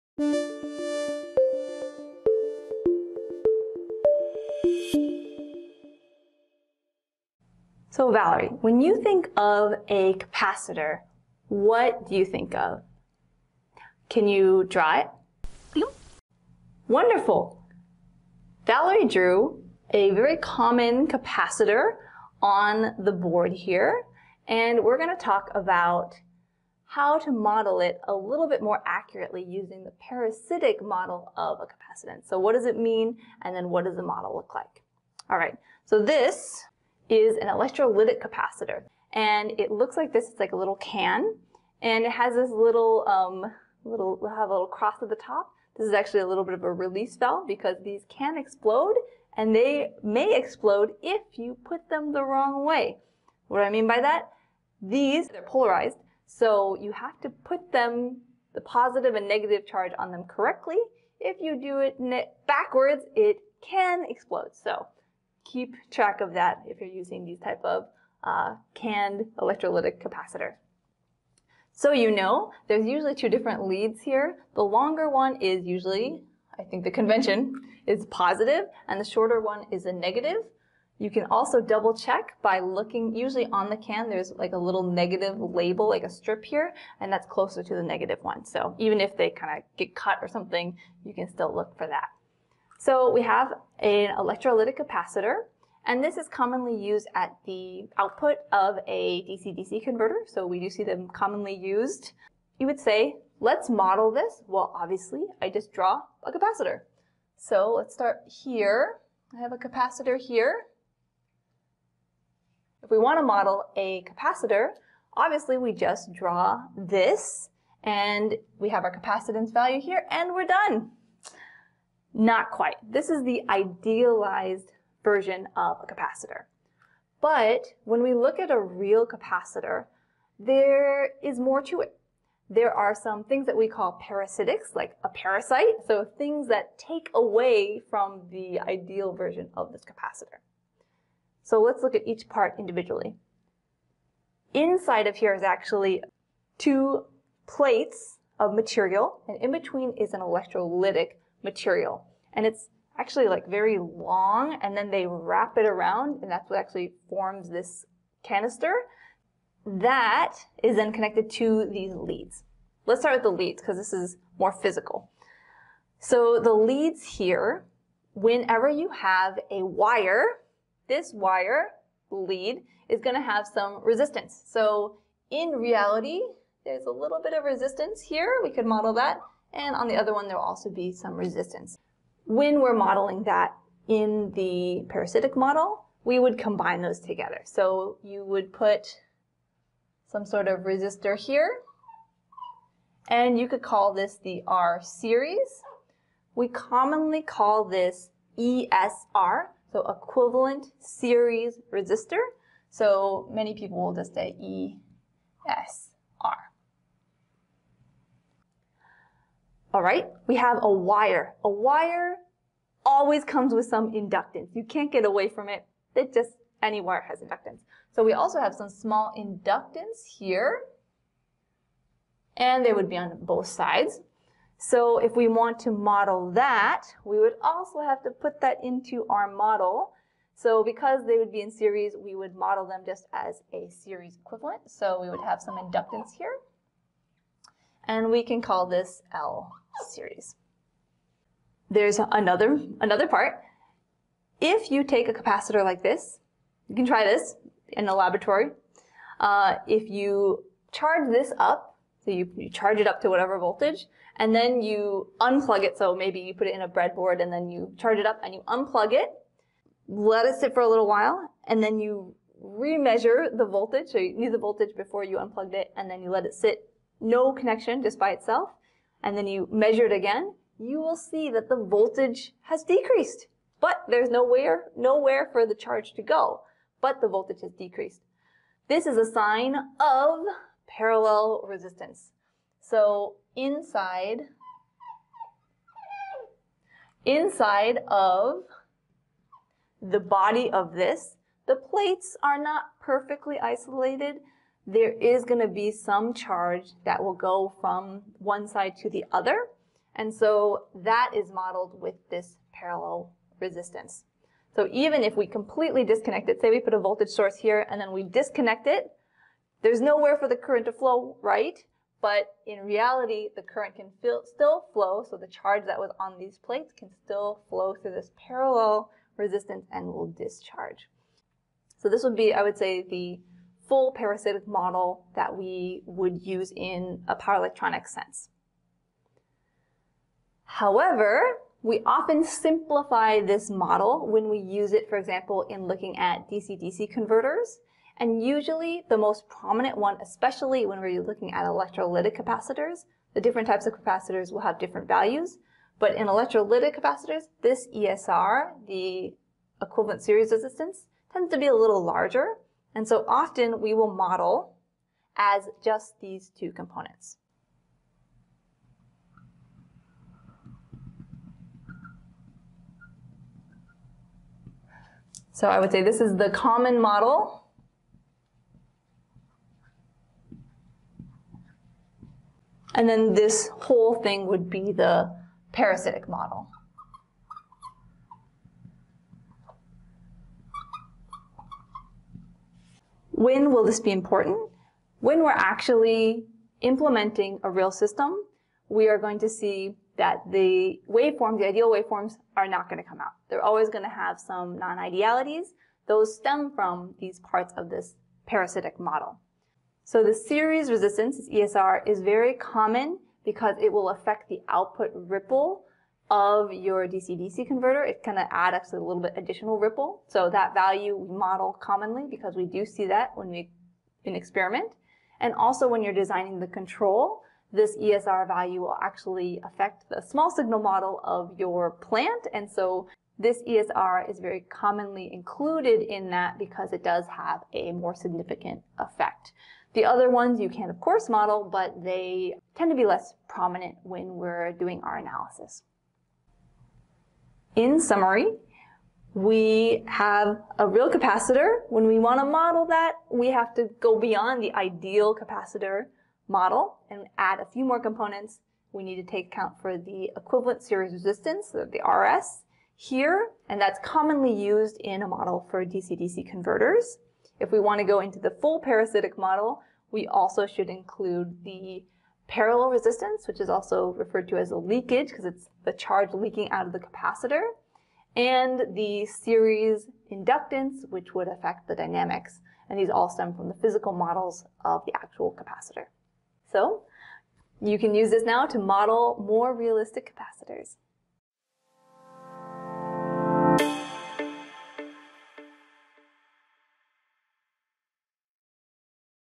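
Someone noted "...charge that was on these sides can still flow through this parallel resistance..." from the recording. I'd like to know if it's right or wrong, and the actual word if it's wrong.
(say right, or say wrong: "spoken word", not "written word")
wrong: "plates", not "sides".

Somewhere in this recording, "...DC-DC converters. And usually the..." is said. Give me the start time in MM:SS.
05:36.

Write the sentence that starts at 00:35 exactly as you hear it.
All right, so this is an electrolytic capacitor.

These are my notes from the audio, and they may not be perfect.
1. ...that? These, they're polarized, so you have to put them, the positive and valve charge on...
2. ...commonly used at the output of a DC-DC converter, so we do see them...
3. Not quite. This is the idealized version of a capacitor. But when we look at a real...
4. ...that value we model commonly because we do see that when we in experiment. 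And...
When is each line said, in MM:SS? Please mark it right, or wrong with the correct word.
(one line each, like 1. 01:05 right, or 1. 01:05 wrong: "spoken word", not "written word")
1. 00:54 wrong: "negative", not "valve"
2. 01:36 right
3. 02:02 right
4. 06:50 right.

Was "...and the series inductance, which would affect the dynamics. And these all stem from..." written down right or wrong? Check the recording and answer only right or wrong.
right.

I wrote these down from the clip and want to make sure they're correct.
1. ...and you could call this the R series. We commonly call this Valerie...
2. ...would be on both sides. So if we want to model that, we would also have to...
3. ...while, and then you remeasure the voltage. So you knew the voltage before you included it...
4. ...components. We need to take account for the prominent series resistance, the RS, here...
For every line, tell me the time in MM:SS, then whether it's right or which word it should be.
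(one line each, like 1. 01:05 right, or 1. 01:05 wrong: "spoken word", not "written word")
1. 03:13 wrong: "ESR", not "Valerie"
2. 03:42 right
3. 04:20 wrong: "unplugged", not "included"
4. 07:27 wrong: "equivalent", not "prominent".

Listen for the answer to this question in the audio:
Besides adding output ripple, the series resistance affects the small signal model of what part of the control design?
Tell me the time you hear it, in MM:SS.
07:01.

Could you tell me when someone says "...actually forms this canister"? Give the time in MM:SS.
02:36.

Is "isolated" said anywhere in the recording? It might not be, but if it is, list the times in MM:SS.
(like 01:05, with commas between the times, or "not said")
04:53.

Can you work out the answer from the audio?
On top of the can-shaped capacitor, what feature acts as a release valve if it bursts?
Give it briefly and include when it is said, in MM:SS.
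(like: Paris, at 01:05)
a little cross, at 00:44.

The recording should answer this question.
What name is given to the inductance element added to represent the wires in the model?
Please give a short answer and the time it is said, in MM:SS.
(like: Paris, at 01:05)
L series, at 03:59.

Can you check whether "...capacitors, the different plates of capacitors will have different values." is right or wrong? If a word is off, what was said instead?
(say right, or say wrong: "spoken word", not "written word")
wrong: "types", not "plates".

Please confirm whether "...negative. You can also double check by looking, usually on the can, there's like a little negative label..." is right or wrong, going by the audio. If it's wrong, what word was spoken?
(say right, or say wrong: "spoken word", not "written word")
right.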